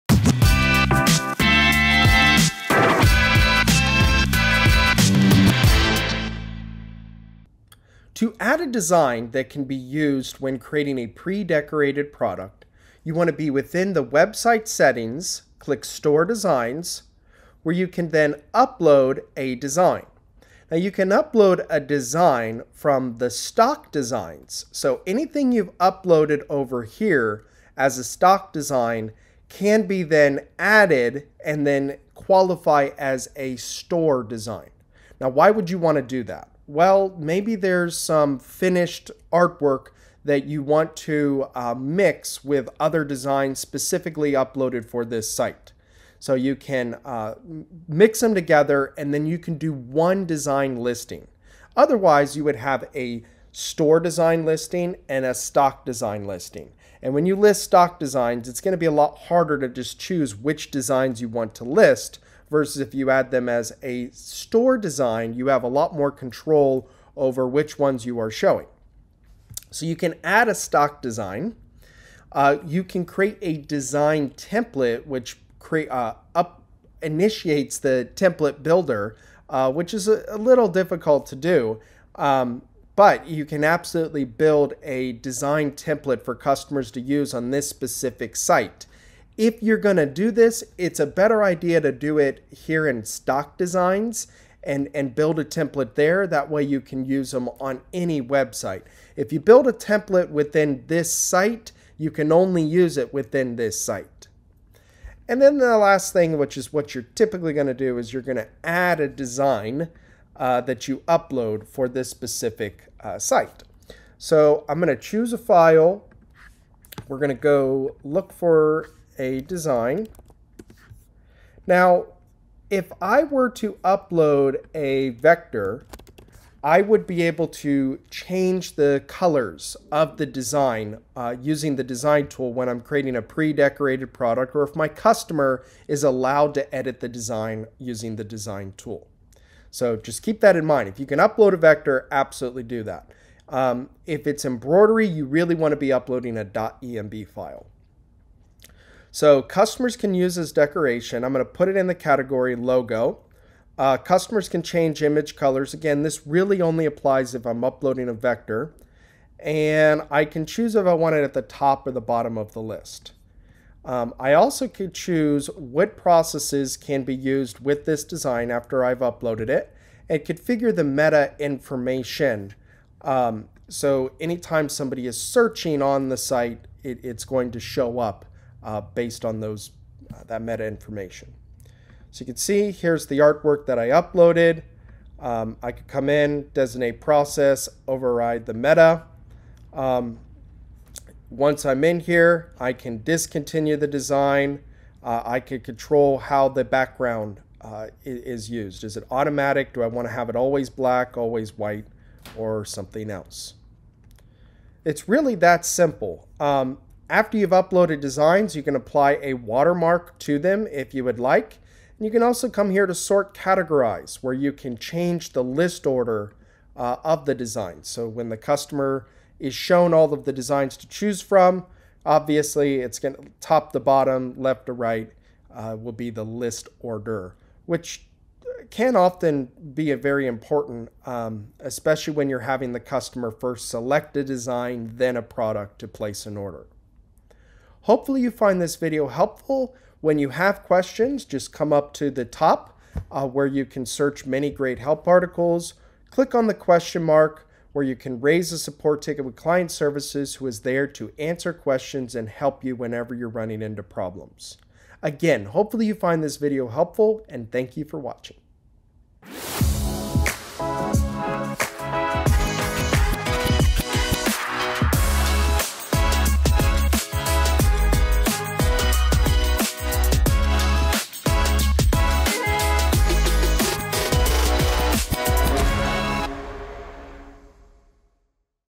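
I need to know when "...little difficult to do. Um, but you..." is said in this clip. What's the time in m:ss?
1:20.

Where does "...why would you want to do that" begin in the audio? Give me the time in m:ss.
0:35.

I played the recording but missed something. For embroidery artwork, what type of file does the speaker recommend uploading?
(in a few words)
.emb file.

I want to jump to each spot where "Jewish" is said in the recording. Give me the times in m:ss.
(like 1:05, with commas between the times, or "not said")
not said.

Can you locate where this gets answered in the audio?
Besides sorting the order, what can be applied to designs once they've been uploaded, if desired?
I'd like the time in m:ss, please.
3:29.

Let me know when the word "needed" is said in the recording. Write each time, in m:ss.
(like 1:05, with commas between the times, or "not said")
not said.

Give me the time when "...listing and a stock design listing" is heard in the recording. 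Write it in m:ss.
0:54.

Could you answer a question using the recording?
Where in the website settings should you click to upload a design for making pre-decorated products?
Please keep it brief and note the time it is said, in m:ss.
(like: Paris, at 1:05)
Store Designs, at 0:15.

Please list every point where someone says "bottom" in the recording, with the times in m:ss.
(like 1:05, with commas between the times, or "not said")
2:42, 3:43.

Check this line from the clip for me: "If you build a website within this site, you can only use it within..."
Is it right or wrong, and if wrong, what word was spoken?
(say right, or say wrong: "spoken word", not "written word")
wrong: "template", not "website".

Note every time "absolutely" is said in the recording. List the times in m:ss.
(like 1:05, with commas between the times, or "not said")
1:23, 2:22.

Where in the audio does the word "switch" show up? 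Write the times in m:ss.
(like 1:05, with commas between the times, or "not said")
not said.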